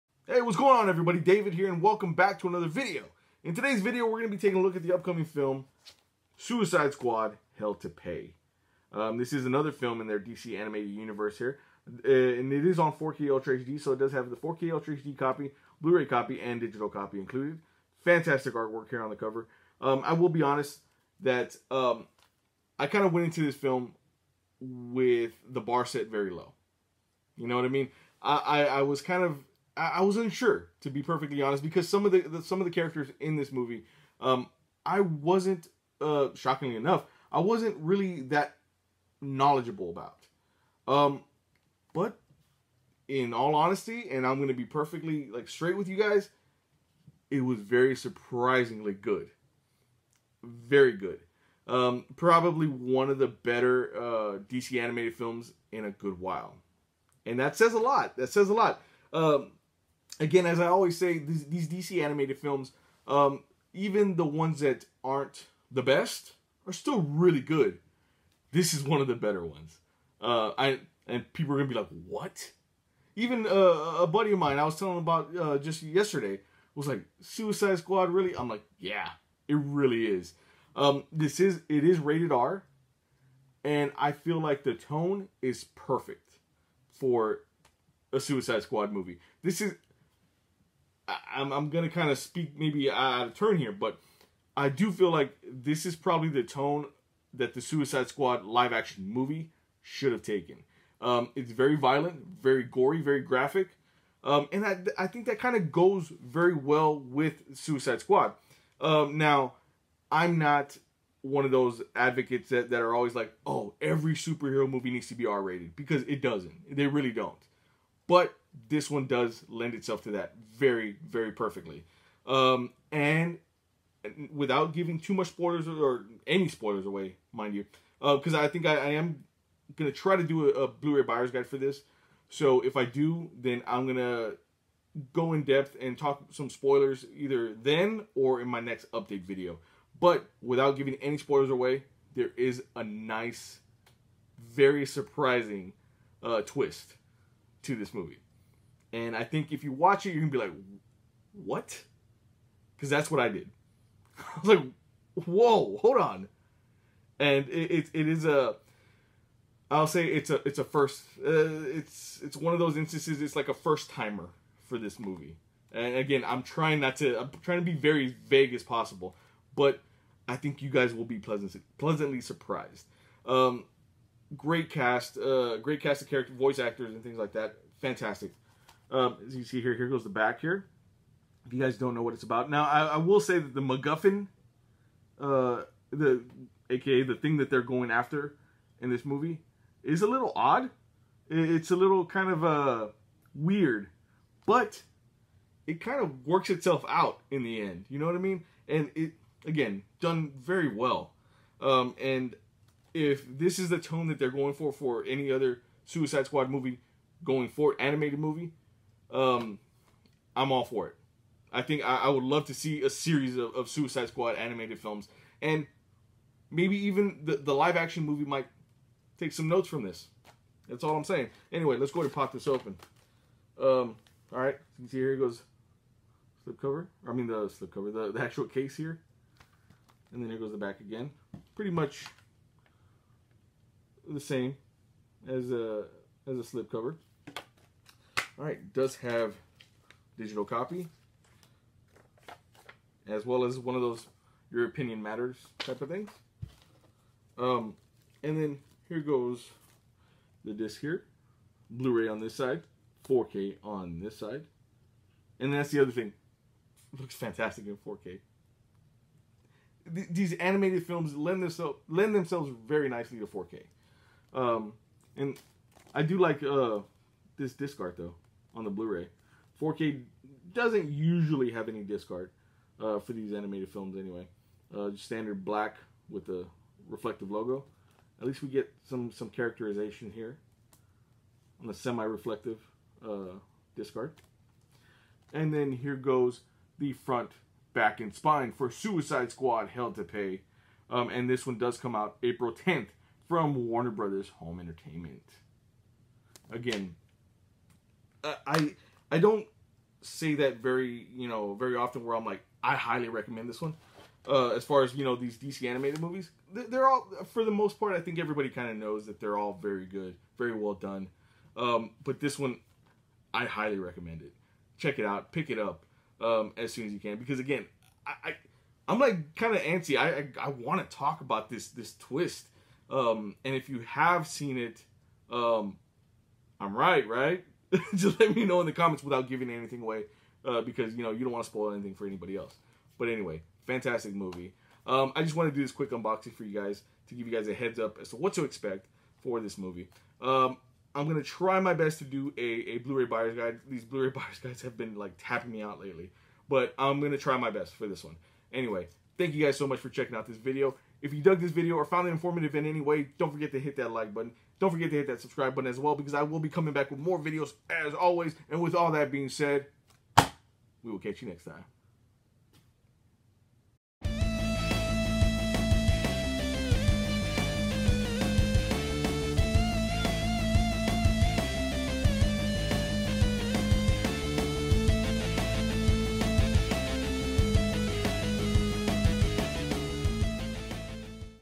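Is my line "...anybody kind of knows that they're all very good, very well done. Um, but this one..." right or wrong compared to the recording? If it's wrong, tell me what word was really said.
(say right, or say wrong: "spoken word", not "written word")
wrong: "everybody", not "anybody".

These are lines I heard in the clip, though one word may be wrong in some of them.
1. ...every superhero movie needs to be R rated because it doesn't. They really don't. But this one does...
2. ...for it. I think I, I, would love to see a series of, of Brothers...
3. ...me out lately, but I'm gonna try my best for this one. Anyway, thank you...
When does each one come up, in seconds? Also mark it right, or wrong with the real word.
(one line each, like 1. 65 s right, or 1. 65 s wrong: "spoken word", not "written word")
1. 113 s right
2. 210 s wrong: "Suicide", not "Brothers"
3. 345 s right.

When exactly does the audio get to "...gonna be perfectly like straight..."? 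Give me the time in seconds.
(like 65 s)
44 s.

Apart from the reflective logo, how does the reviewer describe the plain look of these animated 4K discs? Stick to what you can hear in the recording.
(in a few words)
Standard black.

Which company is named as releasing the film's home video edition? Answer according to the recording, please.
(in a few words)
Warner Brothers Home Entertainment.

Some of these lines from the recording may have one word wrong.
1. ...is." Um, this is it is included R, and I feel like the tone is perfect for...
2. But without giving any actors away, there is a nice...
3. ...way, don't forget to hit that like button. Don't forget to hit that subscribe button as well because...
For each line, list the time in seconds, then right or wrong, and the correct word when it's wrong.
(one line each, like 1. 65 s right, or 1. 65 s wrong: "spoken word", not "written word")
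1. 80 s wrong: "rated", not "included"
2. 139 s wrong: "spoilers", not "actors"
3. 352 s right.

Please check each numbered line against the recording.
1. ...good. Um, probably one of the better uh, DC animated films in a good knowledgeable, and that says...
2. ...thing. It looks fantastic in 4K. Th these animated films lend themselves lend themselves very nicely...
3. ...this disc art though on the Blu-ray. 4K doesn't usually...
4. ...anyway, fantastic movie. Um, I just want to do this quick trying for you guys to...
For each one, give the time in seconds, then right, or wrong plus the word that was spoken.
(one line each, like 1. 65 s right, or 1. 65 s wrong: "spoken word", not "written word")
1. 50 s wrong: "while", not "knowledgeable"
2. 255 s right
3. 267 s right
4. 333 s wrong: "unboxing", not "trying".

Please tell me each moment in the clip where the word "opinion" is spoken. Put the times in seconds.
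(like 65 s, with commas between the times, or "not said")
244 s.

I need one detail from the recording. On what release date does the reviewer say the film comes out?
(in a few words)
April 10th.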